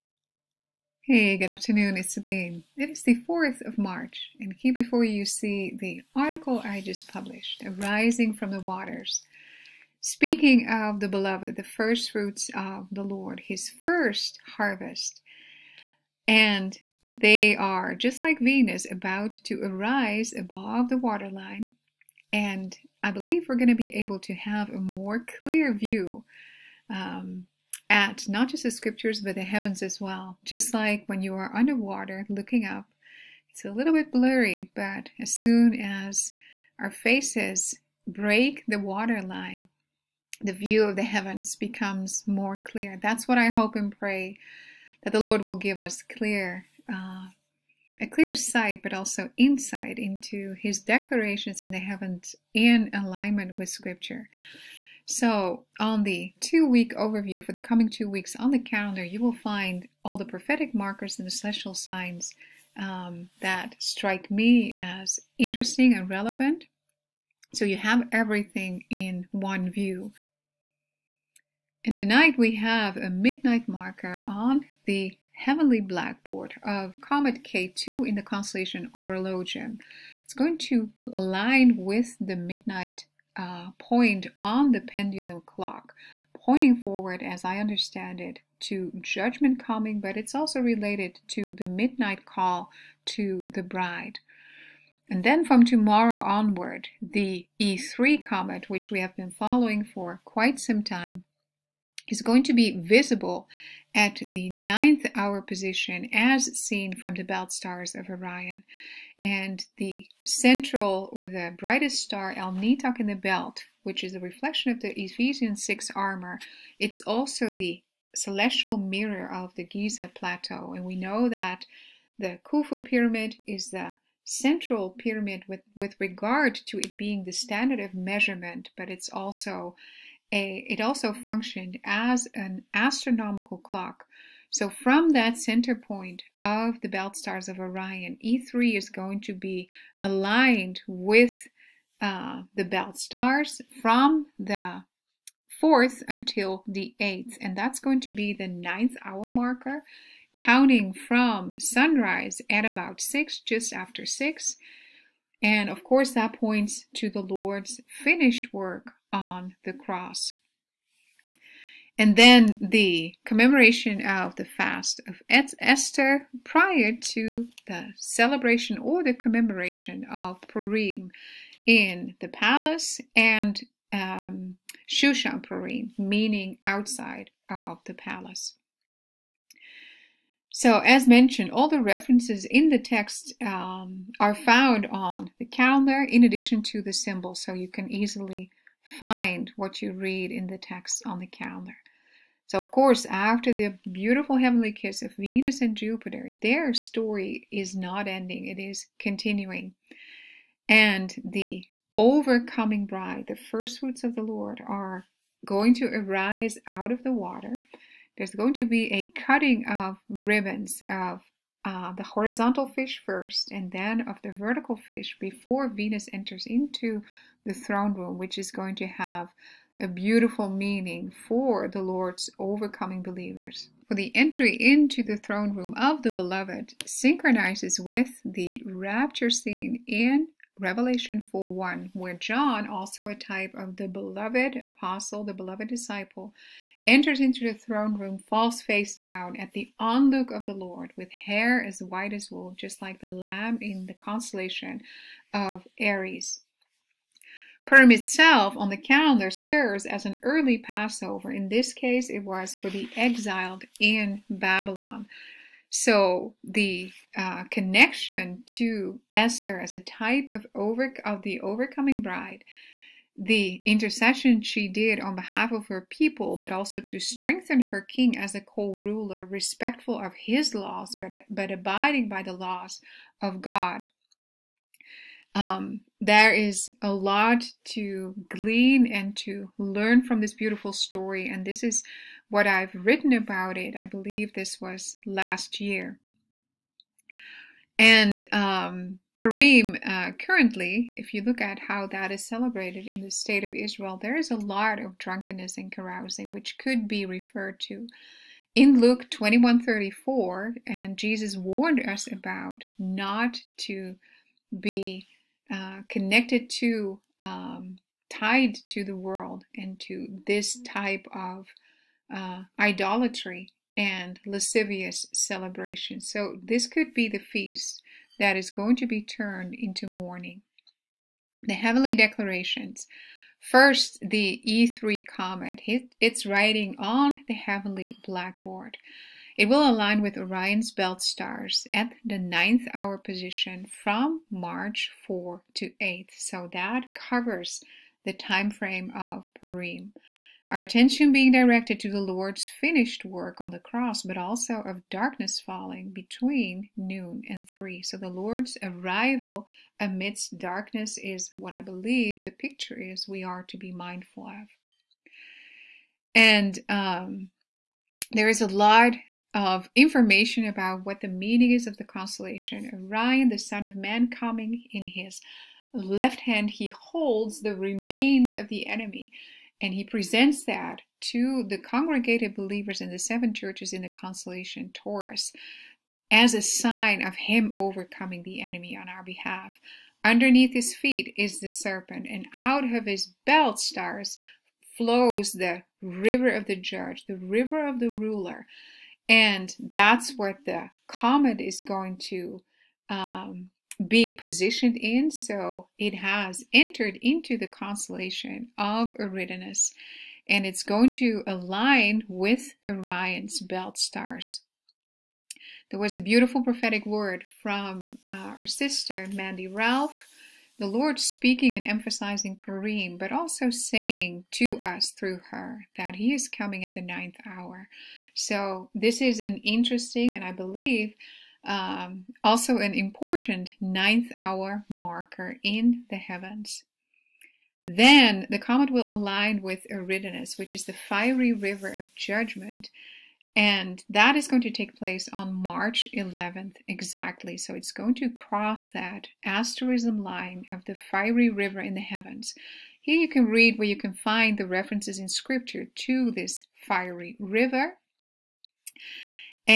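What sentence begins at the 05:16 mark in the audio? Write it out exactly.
So this could be the feast that is going to be turned into mourning.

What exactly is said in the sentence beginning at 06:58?
So, this is an interesting and I believe um, also an important ninth hour marker in the heavens.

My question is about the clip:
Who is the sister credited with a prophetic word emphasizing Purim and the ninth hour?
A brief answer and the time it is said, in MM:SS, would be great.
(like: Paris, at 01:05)
Mandy Ralph, at 06:49.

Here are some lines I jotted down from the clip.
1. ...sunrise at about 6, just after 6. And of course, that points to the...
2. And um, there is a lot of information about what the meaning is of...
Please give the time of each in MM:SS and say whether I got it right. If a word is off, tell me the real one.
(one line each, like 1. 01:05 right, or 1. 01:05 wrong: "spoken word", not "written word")
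1. 02:31 right
2. 05:56 right.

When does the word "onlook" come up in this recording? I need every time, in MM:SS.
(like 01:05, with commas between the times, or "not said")
03:59.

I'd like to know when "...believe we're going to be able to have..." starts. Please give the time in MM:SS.
00:23.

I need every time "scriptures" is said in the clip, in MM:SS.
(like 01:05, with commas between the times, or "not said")
00:28, 00:53, 07:25.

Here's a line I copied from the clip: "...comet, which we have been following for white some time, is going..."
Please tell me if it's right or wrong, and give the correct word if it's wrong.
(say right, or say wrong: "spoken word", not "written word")
wrong: "quite", not "white".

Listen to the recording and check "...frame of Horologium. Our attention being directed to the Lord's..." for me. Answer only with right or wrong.
wrong.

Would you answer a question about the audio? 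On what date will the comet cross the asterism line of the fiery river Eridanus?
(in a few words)
March 11.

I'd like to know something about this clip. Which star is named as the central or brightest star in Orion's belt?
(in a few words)
Alnitak.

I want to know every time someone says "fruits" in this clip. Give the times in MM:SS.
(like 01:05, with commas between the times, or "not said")
00:12, 03:23.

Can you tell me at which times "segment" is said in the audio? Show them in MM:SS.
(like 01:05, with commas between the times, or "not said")
not said.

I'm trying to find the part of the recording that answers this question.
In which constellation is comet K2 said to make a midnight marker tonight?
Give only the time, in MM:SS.
01:18.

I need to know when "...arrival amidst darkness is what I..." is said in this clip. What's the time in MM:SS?
05:48.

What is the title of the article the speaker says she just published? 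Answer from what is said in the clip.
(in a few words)
Arising from the Waters.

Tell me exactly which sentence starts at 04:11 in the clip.
In this case, it was for the exiled in Babylon.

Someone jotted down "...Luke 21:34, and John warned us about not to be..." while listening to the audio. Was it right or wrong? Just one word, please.
wrong.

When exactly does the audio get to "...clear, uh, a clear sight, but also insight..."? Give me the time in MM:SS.
00:46.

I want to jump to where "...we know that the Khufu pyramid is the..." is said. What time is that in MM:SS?
02:00.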